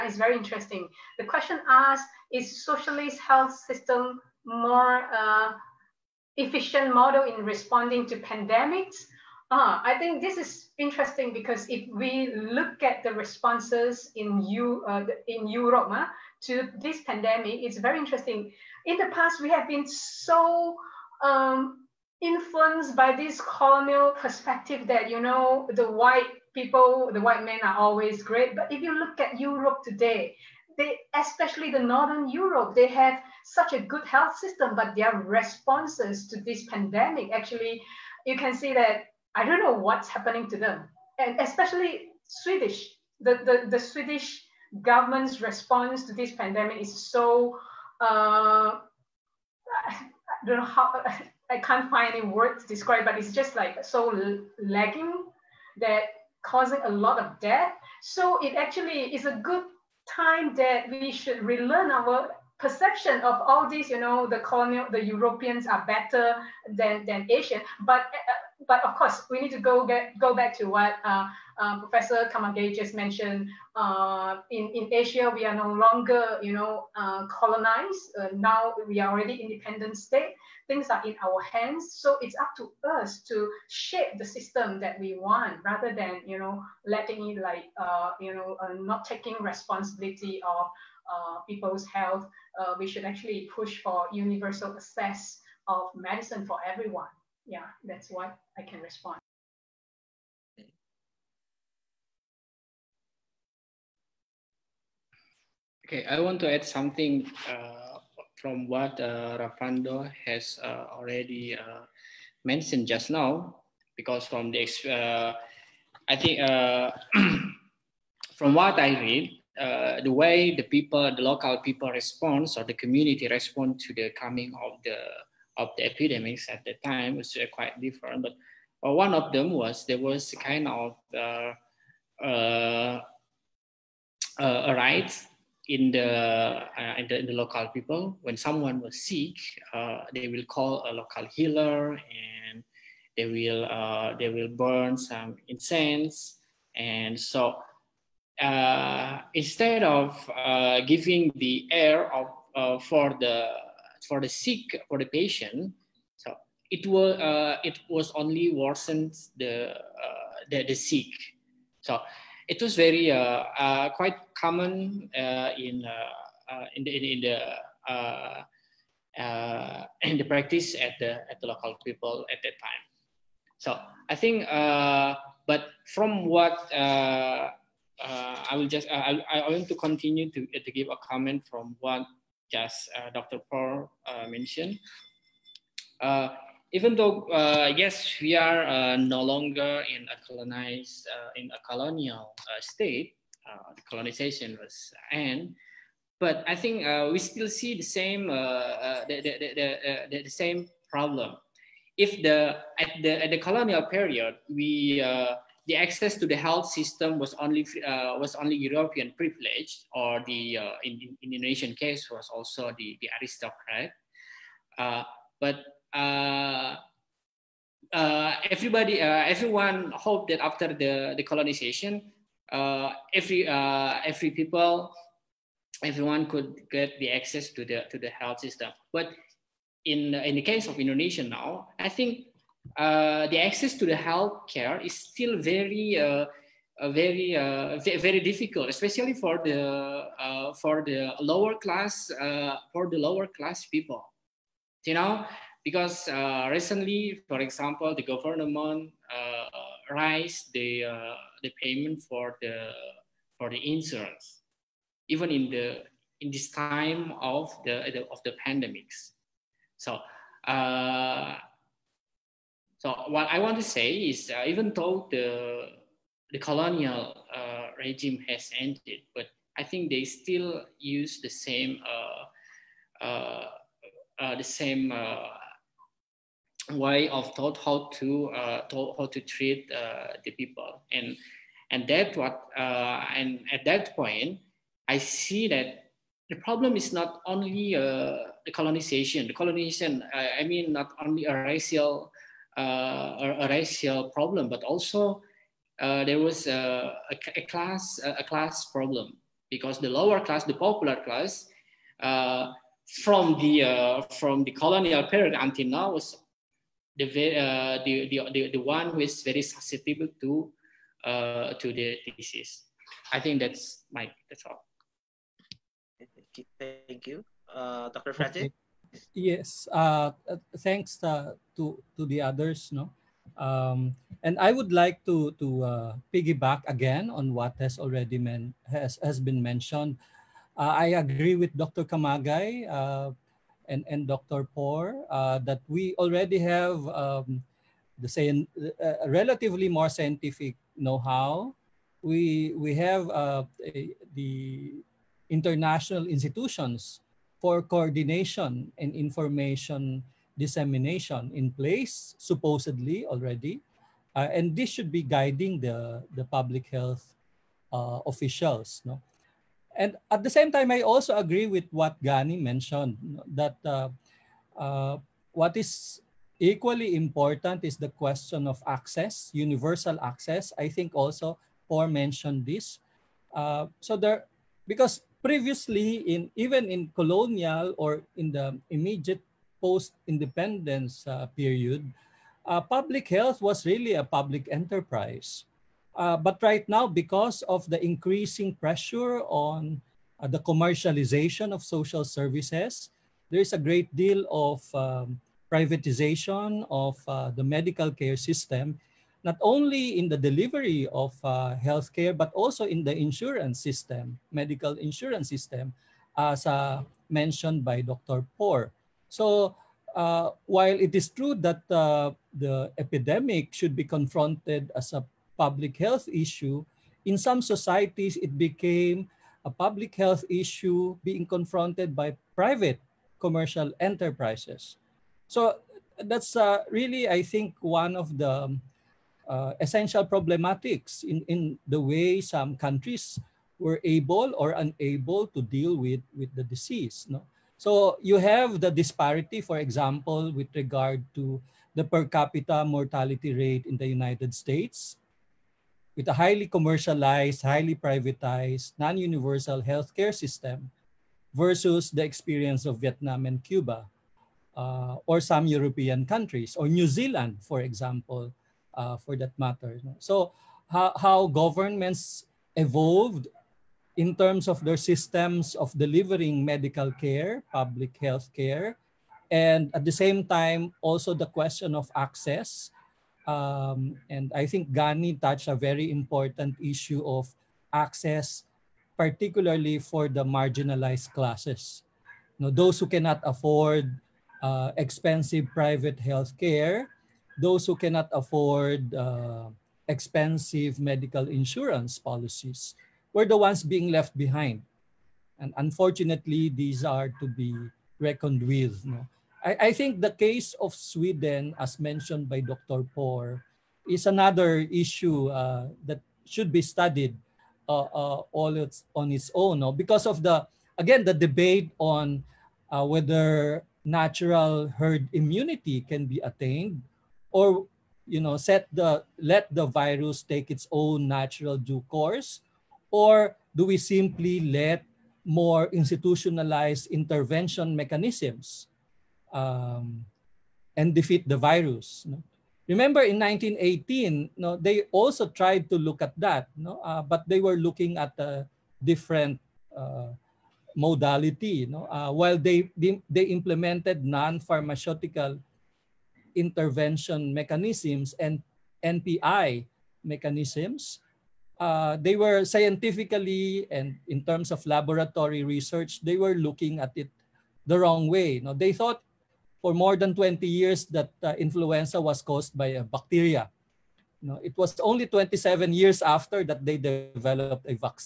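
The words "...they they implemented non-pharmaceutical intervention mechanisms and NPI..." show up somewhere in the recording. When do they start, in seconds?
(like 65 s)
542 s.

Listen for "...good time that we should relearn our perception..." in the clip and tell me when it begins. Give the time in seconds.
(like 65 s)
59 s.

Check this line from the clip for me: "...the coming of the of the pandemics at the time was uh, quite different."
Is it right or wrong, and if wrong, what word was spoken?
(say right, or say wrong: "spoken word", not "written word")
wrong: "epidemics", not "pandemics".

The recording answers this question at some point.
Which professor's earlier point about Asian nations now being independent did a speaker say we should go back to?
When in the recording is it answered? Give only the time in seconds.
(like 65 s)
71 s.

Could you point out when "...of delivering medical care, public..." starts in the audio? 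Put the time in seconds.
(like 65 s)
465 s.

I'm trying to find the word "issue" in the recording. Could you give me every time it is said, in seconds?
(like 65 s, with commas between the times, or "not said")
416 s, 420 s, 476 s, 504 s.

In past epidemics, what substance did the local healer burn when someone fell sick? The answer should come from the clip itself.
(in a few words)
incense.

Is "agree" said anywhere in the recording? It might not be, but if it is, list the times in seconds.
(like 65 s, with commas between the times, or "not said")
331 s, 361 s.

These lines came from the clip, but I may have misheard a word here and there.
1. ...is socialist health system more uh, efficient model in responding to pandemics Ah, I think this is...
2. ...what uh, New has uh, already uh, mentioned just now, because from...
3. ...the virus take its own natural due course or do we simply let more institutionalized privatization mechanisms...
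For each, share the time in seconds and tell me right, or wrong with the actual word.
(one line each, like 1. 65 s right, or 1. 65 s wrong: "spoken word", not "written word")
1. 2 s right
2. 108 s wrong: "Rafando", not "New"
3. 519 s wrong: "intervention", not "privatization".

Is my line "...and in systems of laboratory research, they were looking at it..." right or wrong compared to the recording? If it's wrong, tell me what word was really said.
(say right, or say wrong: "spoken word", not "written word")
wrong: "terms", not "systems".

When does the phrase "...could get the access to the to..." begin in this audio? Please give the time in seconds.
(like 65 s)
226 s.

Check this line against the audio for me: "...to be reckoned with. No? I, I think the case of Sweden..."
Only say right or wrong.
right.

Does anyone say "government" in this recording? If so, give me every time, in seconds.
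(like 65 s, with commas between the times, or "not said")
44 s, 248 s, 461 s.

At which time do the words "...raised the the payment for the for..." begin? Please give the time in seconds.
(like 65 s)
249 s.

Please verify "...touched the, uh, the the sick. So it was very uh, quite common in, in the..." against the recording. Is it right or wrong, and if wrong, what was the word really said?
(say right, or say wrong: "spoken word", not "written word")
wrong: "worsened", not "touched".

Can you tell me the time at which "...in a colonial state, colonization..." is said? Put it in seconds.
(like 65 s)
191 s.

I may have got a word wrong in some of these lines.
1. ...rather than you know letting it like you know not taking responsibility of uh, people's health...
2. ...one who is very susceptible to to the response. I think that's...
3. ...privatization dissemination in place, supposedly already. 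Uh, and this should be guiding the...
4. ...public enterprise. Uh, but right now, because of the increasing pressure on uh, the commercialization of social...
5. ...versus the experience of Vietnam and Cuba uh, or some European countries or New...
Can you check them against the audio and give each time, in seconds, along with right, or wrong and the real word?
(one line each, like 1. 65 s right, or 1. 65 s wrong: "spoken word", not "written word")
1. 85 s right
2. 308 s wrong: "disease", not "response"
3. 348 s wrong: "information", not "privatization"
4. 384 s right
5. 451 s right.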